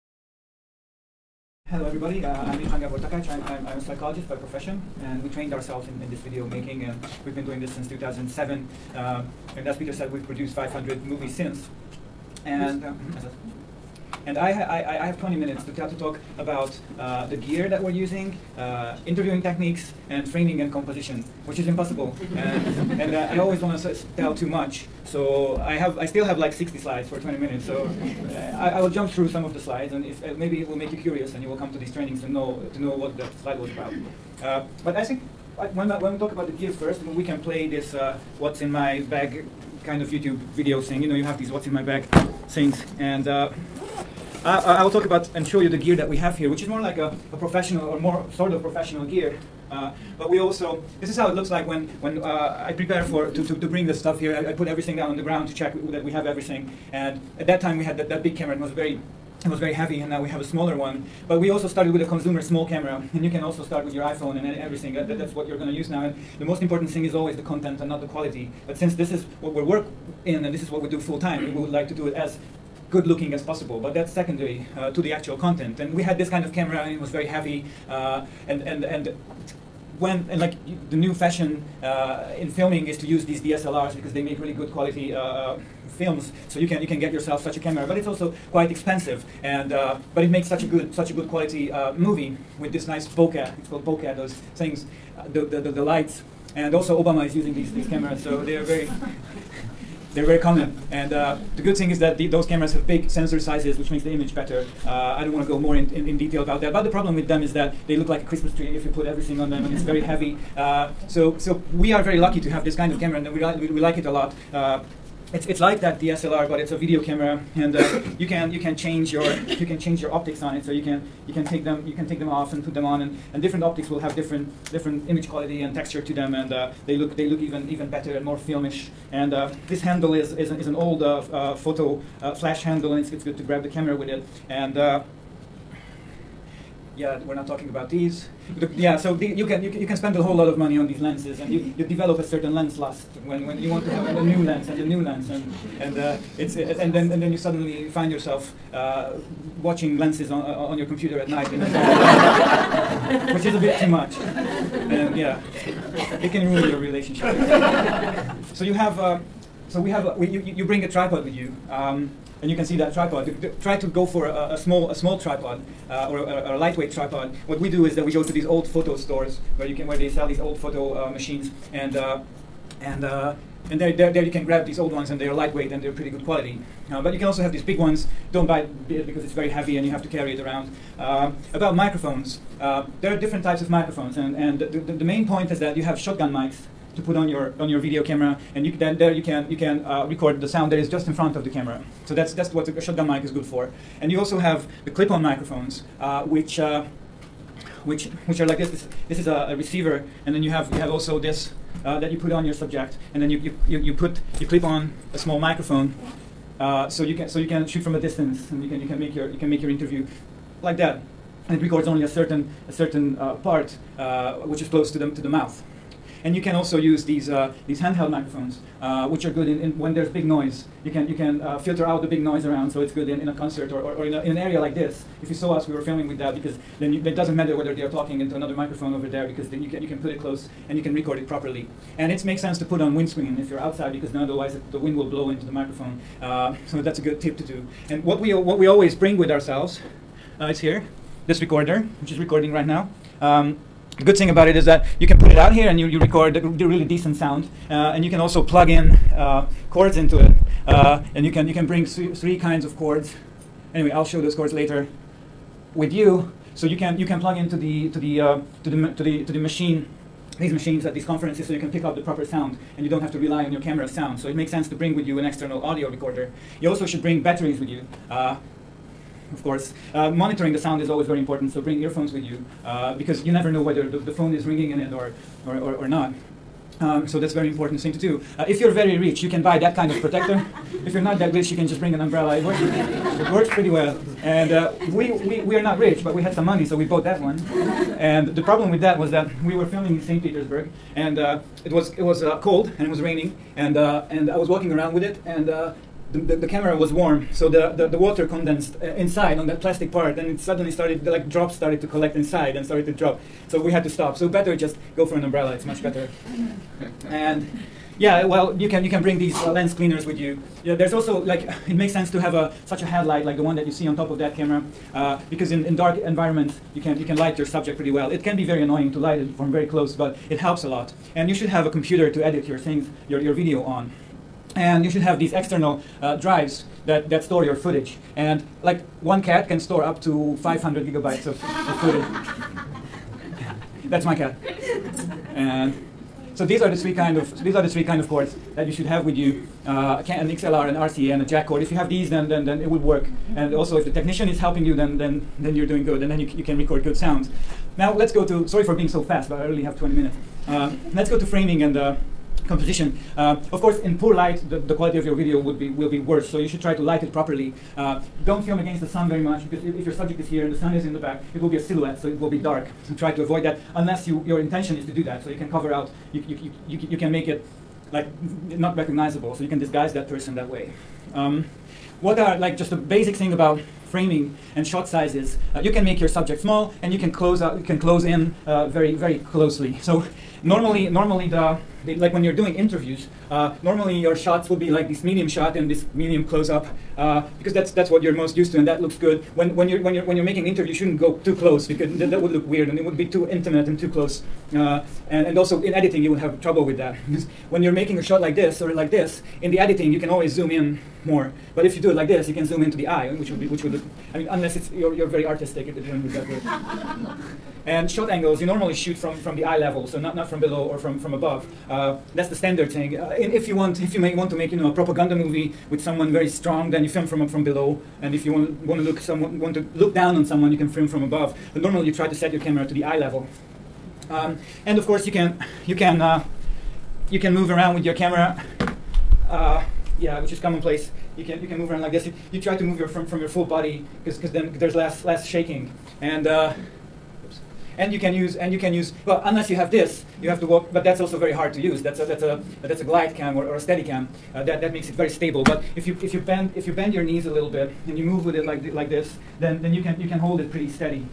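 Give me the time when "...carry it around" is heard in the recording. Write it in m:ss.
3:00.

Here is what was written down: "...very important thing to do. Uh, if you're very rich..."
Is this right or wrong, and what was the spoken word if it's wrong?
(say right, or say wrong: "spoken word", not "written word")
right.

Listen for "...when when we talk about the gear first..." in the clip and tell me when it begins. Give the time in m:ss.
0:35.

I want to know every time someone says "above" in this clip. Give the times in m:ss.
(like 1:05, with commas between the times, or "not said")
6:51, 7:01.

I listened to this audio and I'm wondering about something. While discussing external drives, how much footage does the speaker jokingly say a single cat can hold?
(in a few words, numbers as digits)
500 gigabytes.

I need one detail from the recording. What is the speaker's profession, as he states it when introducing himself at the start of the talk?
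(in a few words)
psychologist.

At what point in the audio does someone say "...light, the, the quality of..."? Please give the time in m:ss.
5:54.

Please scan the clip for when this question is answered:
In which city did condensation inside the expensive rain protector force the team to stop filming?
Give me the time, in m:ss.
4:50.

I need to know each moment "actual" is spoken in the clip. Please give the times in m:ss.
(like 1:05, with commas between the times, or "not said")
1:15.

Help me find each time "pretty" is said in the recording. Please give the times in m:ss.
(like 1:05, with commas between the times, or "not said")
2:55, 4:43, 5:17, 7:30.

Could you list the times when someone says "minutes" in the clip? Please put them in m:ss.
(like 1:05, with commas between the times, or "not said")
0:15, 0:27, 5:49.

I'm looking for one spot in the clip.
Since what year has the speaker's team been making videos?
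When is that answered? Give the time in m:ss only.
0:07.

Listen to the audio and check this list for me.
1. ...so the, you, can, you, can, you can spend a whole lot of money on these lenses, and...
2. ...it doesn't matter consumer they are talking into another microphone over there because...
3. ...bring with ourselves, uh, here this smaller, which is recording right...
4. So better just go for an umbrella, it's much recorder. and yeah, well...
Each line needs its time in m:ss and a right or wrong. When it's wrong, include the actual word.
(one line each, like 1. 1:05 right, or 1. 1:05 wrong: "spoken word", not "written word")
1. 2:18 right
2. 3:47 wrong: "whether", not "consumer"
3. 3:58 wrong: "recorder", not "smaller"
4. 5:04 wrong: "better", not "recorder".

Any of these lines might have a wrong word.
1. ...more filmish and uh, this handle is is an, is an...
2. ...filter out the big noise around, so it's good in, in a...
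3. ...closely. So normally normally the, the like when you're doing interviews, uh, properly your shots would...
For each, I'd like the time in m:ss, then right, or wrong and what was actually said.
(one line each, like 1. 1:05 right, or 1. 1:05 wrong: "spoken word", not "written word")
1. 2:08 right
2. 3:41 right
3. 6:19 wrong: "normally", not "properly".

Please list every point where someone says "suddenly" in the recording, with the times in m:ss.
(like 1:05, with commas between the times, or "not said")
2:27, 5:00.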